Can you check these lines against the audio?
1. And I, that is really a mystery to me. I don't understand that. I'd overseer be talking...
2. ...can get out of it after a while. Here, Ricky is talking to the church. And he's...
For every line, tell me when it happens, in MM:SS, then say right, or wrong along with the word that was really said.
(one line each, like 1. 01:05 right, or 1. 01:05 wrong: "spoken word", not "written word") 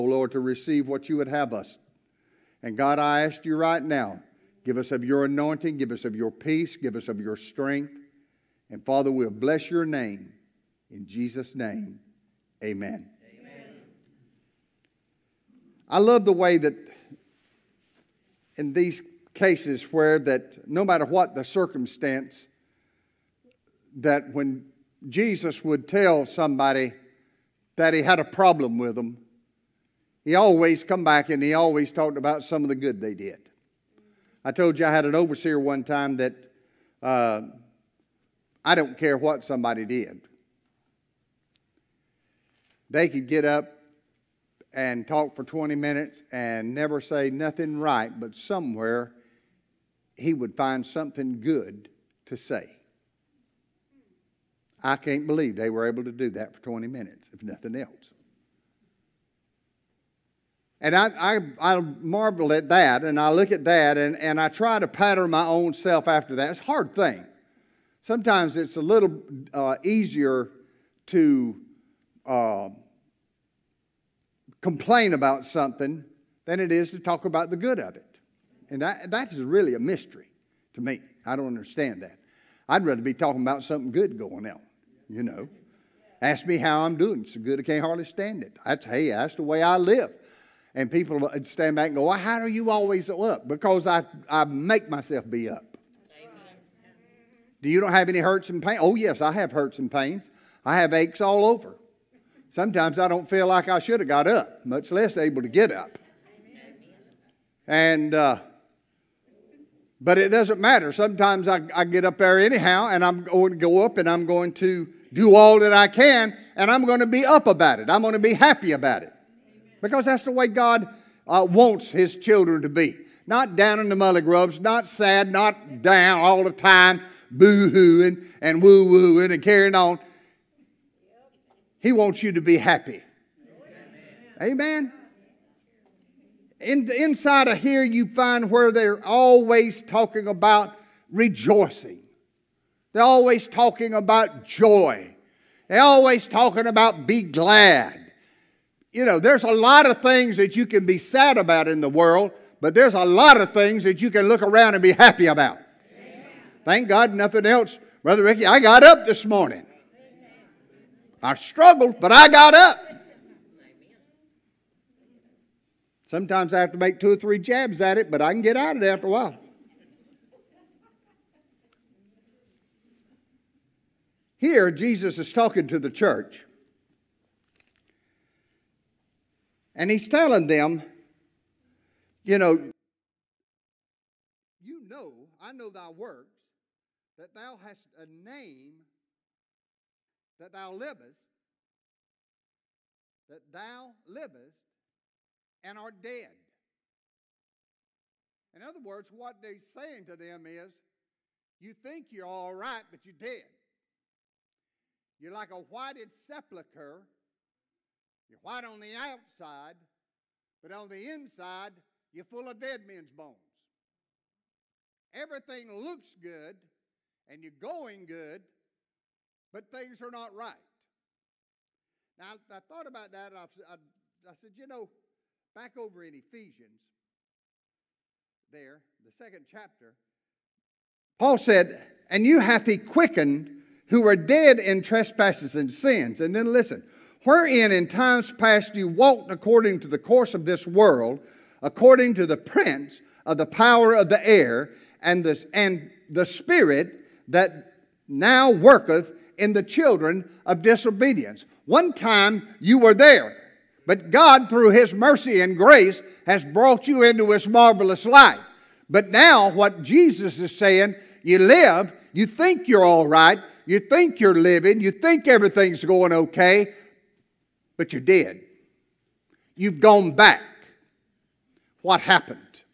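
1. 01:18 wrong: "rather", not "overseer"
2. 02:48 wrong: "Jesus", not "Ricky".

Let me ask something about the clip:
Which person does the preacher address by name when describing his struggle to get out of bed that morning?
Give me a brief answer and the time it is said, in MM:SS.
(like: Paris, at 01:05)
Brother Ricky, at 02:38.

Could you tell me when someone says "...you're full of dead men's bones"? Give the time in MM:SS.
03:32.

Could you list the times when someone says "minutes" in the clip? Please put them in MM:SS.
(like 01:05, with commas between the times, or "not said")
00:45, 00:56.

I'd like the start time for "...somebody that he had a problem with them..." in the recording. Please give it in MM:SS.
00:26.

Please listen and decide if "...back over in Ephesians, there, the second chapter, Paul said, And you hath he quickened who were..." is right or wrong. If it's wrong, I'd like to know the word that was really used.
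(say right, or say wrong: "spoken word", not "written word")
right.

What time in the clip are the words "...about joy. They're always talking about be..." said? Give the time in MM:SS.
02:23.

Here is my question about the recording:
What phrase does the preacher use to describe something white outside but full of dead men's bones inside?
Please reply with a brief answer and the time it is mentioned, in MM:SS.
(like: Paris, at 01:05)
whited sepulcher, at 03:25.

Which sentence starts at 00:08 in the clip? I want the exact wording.
And Father, we'll bless your name.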